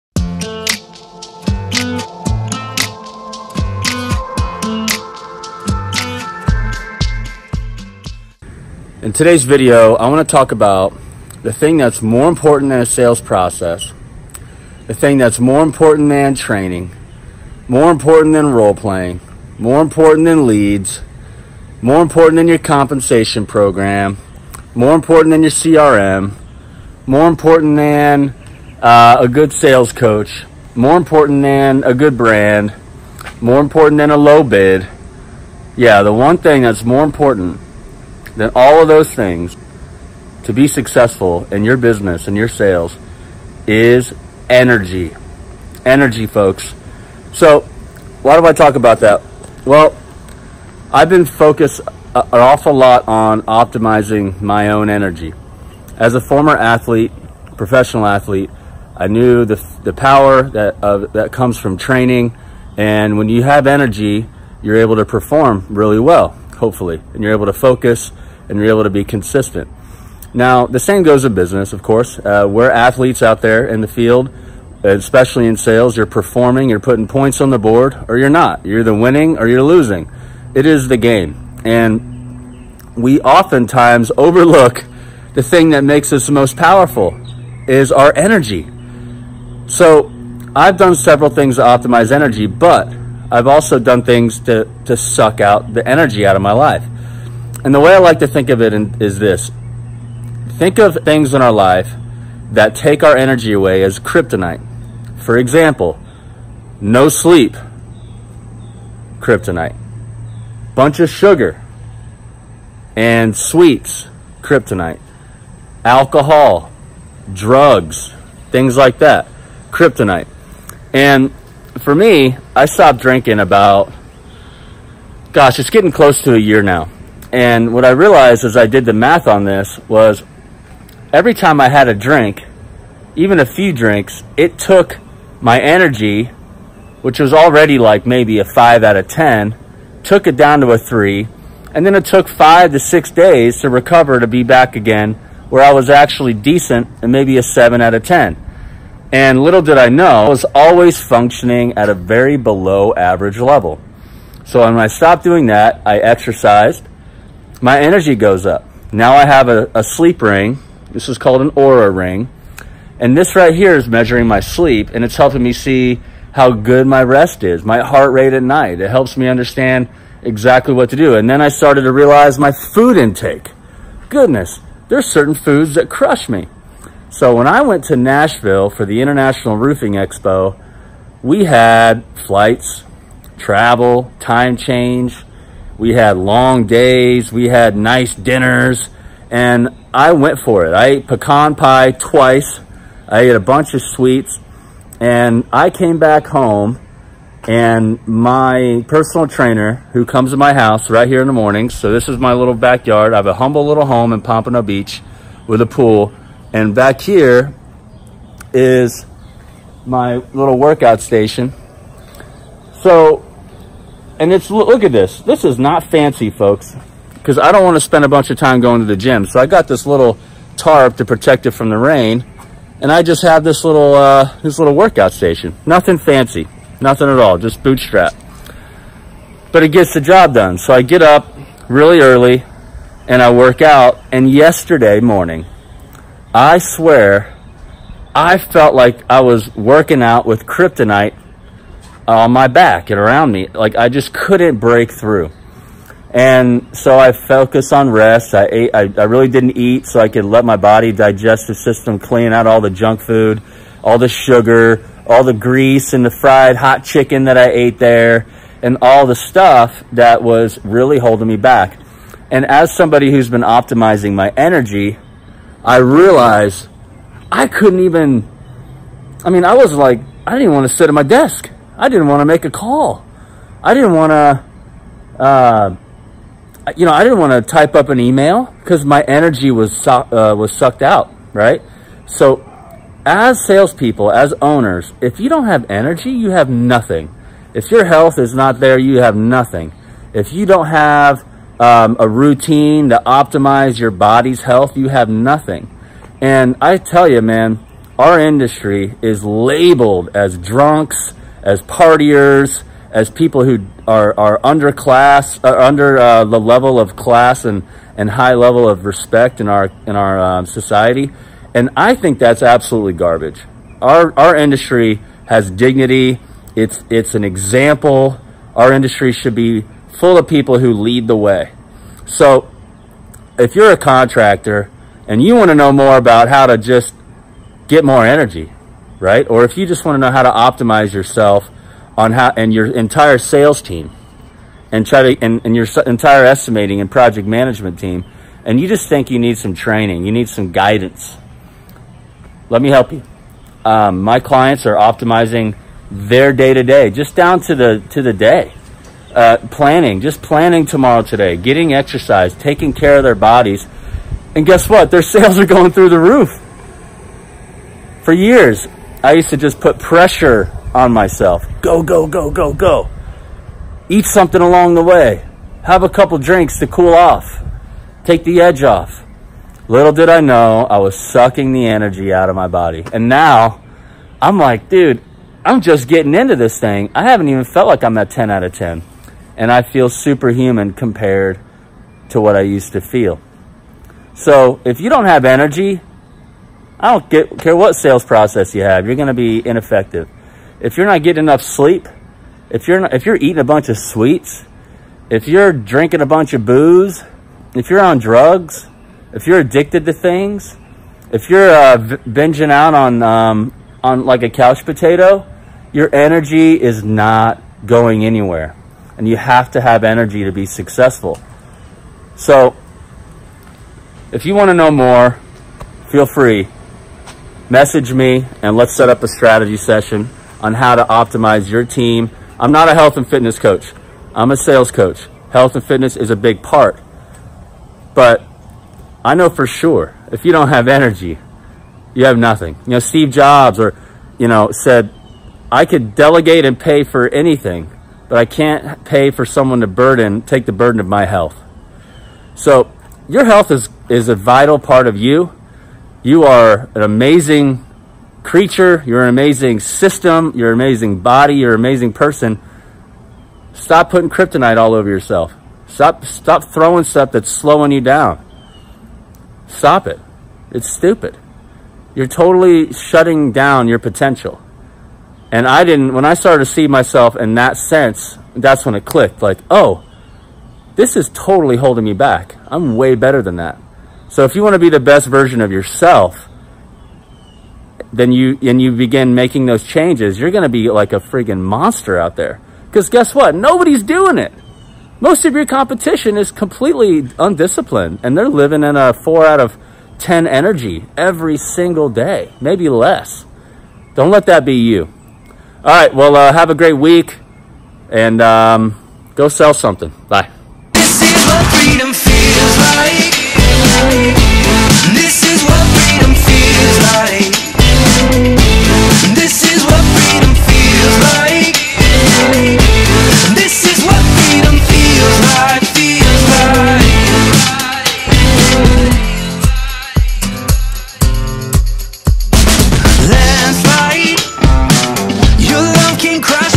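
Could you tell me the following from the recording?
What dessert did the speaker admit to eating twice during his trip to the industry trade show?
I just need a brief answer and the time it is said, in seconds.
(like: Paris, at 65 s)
Pecan pie, at 191 s.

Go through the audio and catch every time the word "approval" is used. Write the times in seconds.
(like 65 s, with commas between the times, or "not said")
not said.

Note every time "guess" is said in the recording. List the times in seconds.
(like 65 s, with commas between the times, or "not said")
354 s, 482 s.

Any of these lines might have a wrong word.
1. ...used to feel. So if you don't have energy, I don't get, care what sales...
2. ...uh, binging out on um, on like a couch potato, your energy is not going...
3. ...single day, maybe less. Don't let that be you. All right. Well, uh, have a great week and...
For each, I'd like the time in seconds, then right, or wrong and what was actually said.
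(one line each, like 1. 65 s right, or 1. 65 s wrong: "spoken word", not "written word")
1. 382 s right
2. 401 s right
3. 491 s right.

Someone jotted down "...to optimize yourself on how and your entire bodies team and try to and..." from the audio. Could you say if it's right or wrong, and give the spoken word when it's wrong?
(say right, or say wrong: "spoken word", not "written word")
wrong: "sales", not "bodies".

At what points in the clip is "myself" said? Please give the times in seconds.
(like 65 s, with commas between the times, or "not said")
360 s, 466 s.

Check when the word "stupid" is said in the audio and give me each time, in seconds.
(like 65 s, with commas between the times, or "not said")
460 s.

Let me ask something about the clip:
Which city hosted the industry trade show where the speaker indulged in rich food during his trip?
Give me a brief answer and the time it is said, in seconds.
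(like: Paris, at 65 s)
Nashville, at 177 s.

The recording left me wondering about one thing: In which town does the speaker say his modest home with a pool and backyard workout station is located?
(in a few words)
Pompano Beach.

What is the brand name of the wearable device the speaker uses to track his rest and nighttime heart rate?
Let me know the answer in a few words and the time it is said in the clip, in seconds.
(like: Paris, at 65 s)
Oura ring, at 161 s.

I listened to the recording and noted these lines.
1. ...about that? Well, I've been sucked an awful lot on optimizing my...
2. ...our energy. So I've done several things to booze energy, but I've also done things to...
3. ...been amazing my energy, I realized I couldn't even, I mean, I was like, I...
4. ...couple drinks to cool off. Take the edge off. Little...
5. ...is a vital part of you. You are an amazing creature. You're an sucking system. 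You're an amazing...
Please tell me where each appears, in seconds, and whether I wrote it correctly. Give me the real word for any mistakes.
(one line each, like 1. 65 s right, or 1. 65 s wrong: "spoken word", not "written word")
1. 48 s wrong: "focused", not "sucked"
2. 87 s wrong: "optimize", not "booze"
3. 263 s wrong: "optimizing", not "amazing"
4. 365 s right
5. 443 s wrong: "amazing", not "sucking".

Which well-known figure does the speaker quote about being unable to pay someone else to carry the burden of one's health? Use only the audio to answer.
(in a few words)
Steve Jobs.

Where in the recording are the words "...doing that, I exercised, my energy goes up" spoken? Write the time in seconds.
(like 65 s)
155 s.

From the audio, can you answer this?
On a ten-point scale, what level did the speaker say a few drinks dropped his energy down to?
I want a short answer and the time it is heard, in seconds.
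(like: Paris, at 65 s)
3, at 140 s.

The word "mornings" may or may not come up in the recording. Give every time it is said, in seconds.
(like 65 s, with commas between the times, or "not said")
201 s, 234 s.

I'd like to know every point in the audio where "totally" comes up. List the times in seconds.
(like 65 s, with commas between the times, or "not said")
462 s, 471 s.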